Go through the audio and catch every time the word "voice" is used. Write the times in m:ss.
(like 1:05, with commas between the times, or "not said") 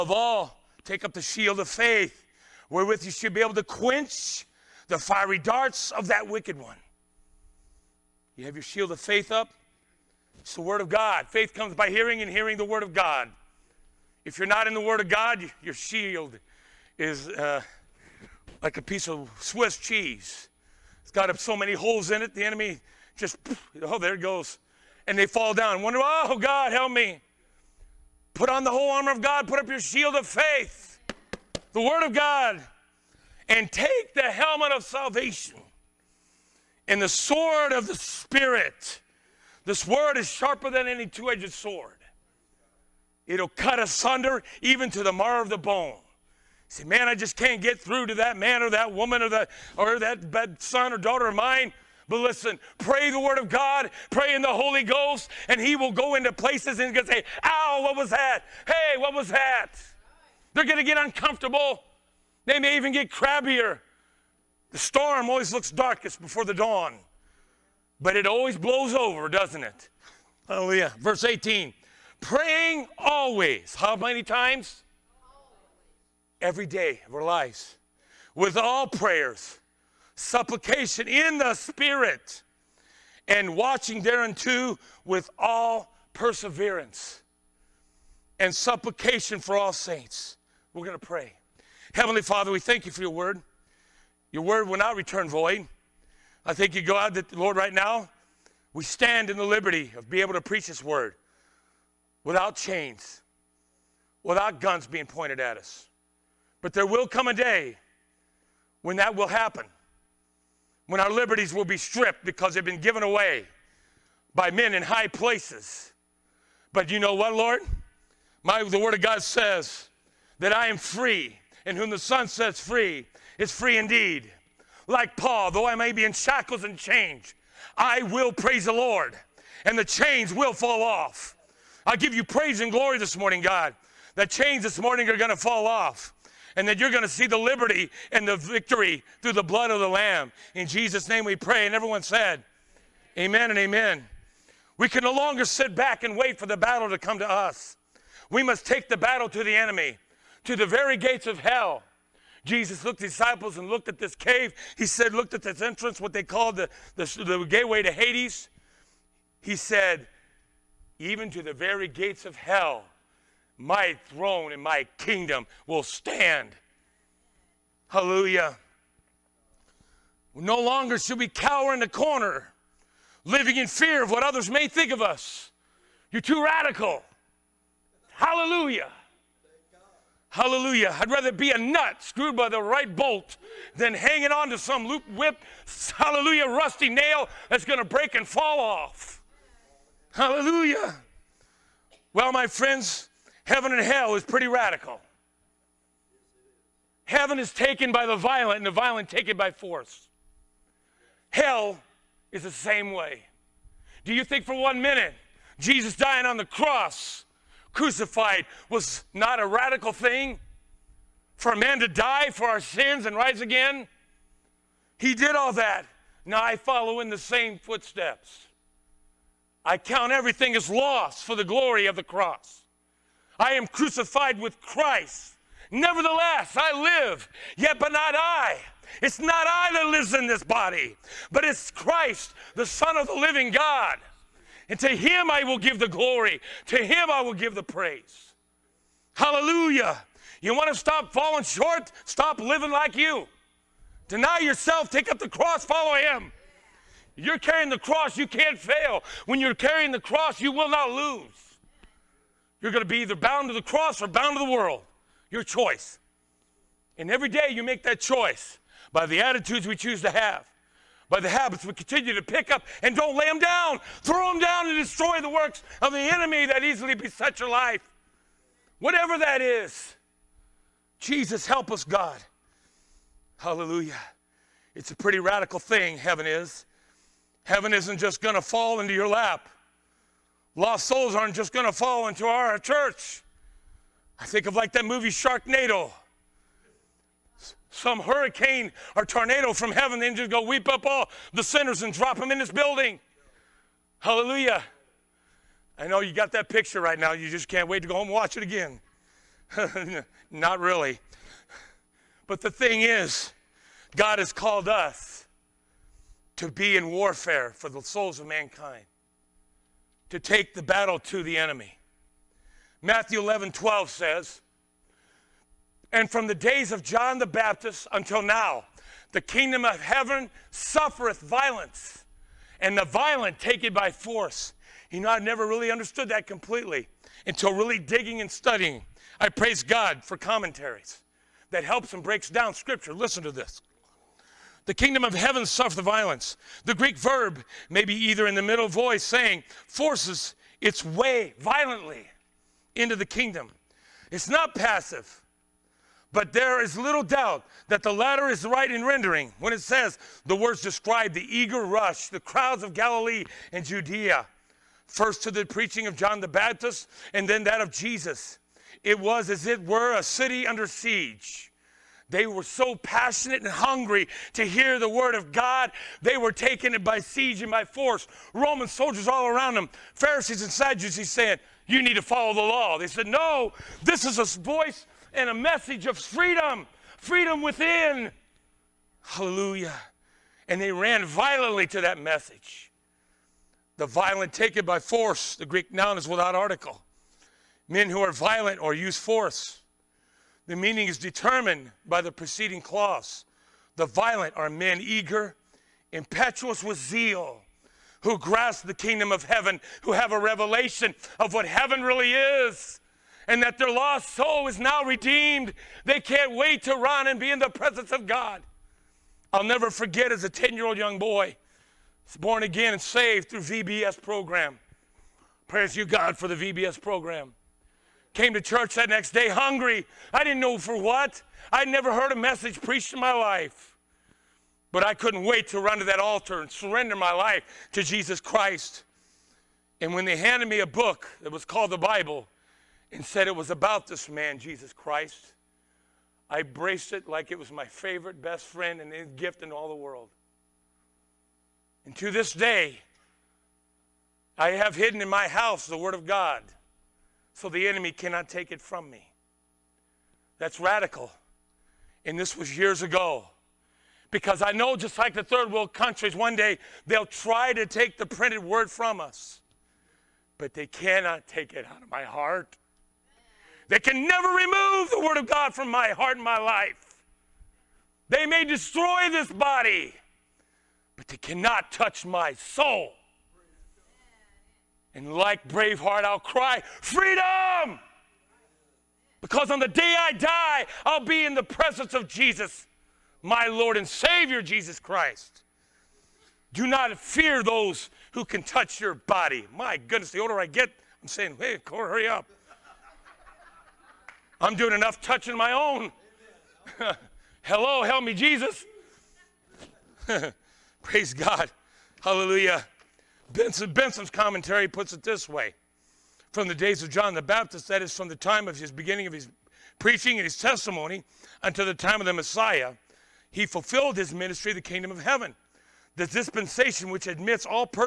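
5:38, 6:14.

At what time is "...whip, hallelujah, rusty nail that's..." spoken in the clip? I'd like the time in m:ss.
3:05.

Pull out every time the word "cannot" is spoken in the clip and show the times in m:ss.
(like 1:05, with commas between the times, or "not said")
7:27, 7:40, 7:51.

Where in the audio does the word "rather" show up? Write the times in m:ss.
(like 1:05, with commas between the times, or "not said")
3:01.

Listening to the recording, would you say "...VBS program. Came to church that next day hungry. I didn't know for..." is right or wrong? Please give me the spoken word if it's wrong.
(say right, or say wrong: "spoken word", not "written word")
right.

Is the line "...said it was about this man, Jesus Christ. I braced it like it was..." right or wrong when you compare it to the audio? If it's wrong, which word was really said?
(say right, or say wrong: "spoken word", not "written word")
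right.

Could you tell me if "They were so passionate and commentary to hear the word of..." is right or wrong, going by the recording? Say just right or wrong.
wrong.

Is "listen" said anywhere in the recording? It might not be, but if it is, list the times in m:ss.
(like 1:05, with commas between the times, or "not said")
0:52, 5:32.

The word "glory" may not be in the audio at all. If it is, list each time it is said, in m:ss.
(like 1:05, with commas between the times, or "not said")
2:12, 3:41, 3:55.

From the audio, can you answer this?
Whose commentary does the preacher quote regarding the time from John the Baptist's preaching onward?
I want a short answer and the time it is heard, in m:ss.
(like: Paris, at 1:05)
Benson's commentary, at 8:23.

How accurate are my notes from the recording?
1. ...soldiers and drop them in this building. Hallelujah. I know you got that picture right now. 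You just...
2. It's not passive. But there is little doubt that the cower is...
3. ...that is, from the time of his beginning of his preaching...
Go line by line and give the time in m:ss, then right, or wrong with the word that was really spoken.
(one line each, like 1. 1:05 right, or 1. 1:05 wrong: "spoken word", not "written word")
1. 4:51 wrong: "sinners", not "soldiers"
2. 5:44 wrong: "latter", not "cower"
3. 8:27 right.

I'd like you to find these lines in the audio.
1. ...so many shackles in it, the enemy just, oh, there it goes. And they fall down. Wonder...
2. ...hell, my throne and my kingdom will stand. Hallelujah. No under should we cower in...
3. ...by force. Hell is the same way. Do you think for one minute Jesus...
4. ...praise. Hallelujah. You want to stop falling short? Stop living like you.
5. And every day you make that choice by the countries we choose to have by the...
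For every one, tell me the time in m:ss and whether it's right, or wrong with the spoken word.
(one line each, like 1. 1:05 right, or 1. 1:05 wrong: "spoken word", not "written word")
1. 0:21 wrong: "holes", not "shackles"
2. 2:42 wrong: "longer", not "under"
3. 3:19 right
4. 3:57 right
5. 4:16 wrong: "attitudes", not "countries".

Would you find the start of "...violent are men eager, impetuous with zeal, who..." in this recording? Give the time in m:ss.
6:33.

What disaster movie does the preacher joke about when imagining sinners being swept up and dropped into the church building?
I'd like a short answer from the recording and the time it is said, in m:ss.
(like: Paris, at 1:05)
Sharknado, at 4:45.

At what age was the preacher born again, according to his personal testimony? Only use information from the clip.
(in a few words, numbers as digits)
10.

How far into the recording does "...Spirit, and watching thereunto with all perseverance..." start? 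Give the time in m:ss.
1:21.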